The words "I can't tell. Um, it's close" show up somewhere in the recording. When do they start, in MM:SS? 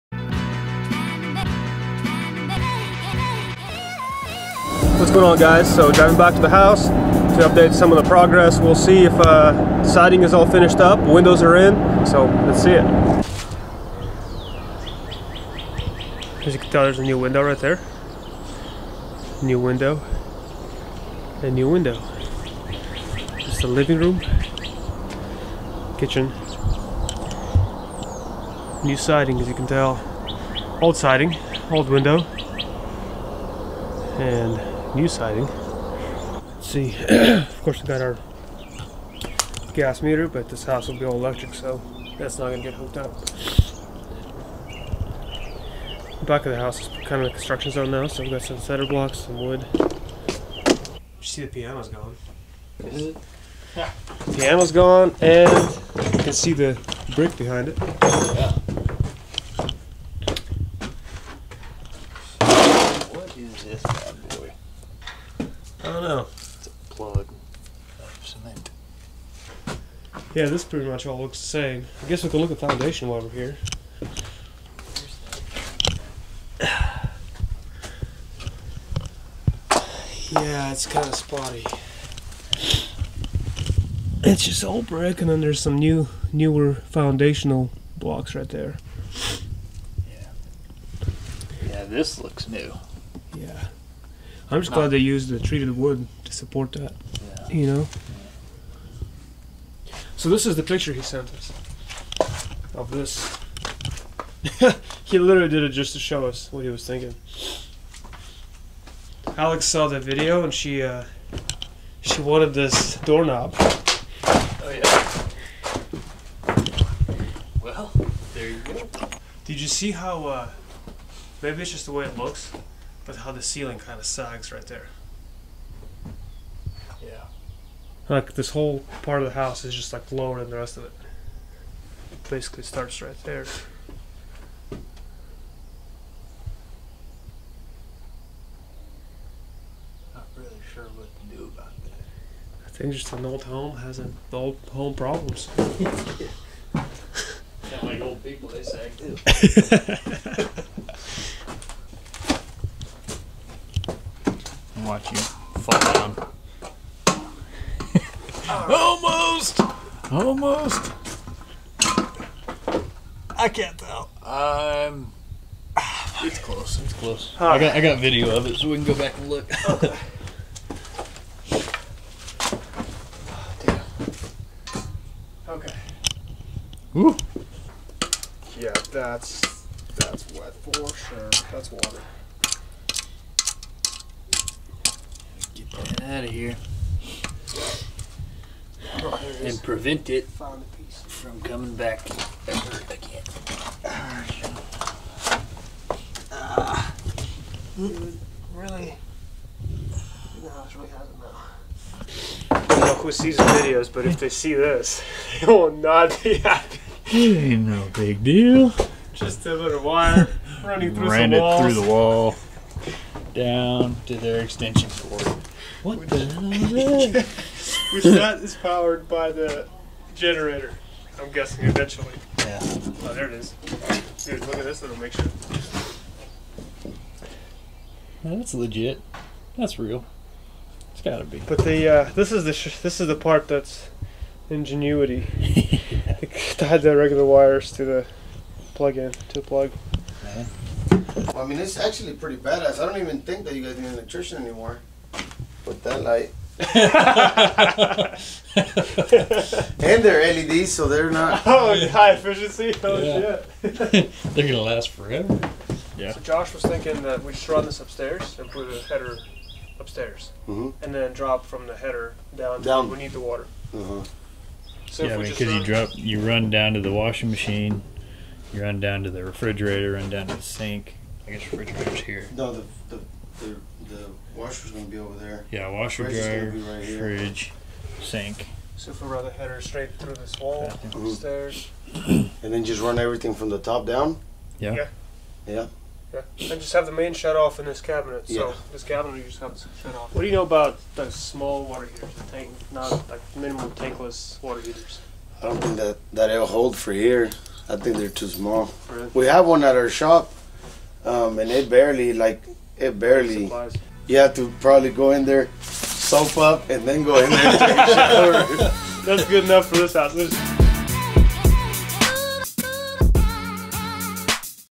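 02:43.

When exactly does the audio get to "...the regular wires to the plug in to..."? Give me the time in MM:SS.
03:56.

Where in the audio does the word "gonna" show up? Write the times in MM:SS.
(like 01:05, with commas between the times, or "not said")
00:42, 04:14, 04:34.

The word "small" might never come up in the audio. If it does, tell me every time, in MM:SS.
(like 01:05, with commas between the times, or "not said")
04:51, 04:58.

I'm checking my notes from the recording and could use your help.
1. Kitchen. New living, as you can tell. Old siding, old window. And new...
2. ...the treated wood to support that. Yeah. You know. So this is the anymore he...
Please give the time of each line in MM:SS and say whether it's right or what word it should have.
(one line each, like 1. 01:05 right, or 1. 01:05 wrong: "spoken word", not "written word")
1. 00:25 wrong: "siding", not "living"
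2. 01:35 wrong: "picture", not "anymore".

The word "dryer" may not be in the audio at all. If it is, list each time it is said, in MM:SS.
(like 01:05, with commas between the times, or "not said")
04:36.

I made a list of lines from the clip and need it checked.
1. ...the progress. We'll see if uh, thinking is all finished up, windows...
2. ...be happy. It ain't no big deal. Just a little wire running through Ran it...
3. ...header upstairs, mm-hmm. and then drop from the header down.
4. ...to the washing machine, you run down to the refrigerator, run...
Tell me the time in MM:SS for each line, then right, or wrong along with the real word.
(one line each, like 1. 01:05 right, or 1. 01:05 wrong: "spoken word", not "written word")
1. 00:08 wrong: "siding", not "thinking"
2. 03:26 right
3. 04:18 right
4. 04:26 right.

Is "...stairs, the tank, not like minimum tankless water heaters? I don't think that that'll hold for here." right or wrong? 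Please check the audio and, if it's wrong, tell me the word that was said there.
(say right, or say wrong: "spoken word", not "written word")
wrong: "heaters", not "stairs".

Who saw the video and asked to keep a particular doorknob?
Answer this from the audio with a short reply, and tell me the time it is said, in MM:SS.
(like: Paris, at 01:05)
Alex, at 01:49.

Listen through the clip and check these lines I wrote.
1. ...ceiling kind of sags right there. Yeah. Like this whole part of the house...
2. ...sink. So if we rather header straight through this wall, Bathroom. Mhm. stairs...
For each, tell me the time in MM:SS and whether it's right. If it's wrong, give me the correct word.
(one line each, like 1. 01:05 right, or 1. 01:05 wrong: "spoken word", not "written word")
1. 02:03 right
2. 04:38 right.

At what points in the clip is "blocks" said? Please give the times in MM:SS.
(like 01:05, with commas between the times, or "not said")
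00:48, 01:27.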